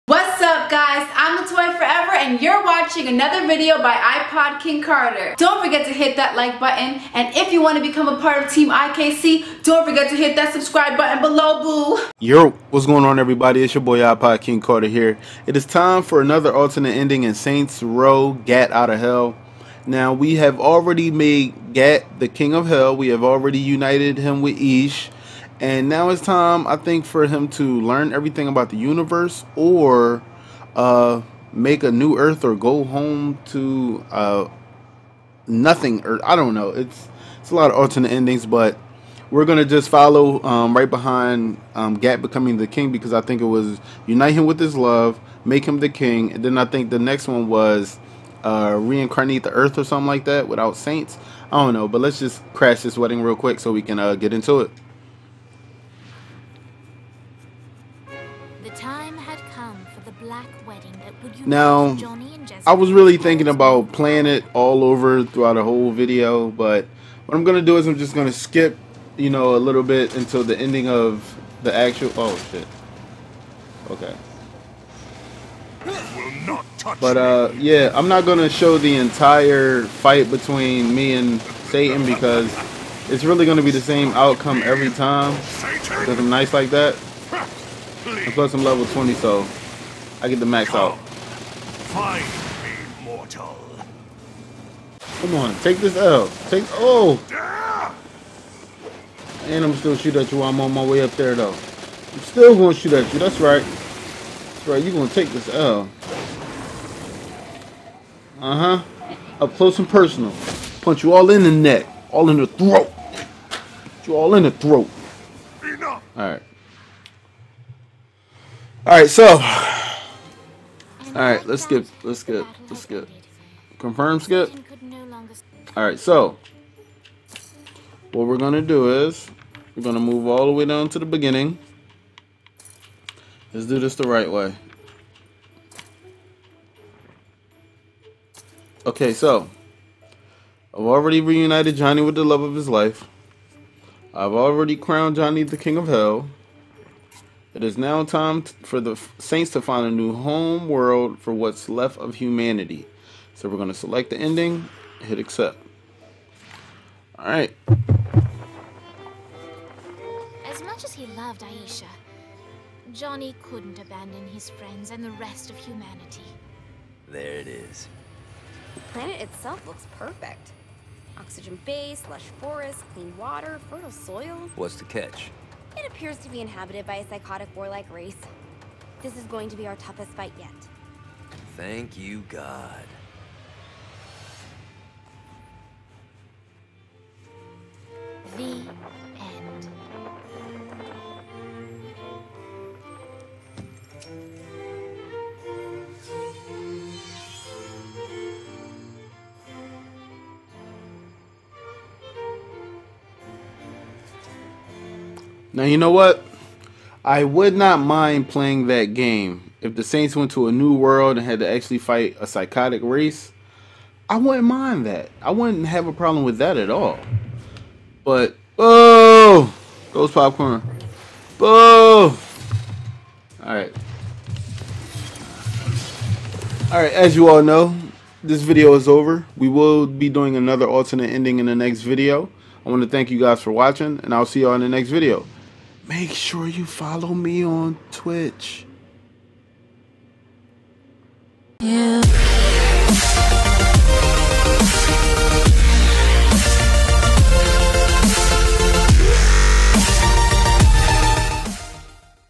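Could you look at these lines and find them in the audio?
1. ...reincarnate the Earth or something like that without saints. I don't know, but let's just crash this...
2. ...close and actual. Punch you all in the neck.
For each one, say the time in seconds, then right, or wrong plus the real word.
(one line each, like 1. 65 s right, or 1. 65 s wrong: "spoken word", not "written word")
1. 48 s right
2. 109 s wrong: "personal", not "actual".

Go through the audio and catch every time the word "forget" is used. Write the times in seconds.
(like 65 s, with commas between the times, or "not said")
5 s, 9 s.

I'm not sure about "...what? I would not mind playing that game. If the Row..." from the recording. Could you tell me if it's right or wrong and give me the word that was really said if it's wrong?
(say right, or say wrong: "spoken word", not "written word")
wrong: "Saints", not "Row".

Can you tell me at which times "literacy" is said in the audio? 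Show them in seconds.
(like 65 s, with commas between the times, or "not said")
not said.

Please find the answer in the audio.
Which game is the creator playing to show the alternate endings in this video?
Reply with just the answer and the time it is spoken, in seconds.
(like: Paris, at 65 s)
Saints Row Gat Out of Hell, at 17 s.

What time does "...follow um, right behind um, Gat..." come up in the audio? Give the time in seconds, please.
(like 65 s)
39 s.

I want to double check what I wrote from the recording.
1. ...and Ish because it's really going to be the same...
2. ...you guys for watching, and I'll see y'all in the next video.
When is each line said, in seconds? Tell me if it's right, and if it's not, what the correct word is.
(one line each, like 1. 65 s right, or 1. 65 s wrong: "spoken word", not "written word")
1. 81 s wrong: "Satan", not "Ish"
2. 233 s right.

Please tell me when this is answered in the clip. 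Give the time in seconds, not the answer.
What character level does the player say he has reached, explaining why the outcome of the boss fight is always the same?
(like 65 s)
88 s.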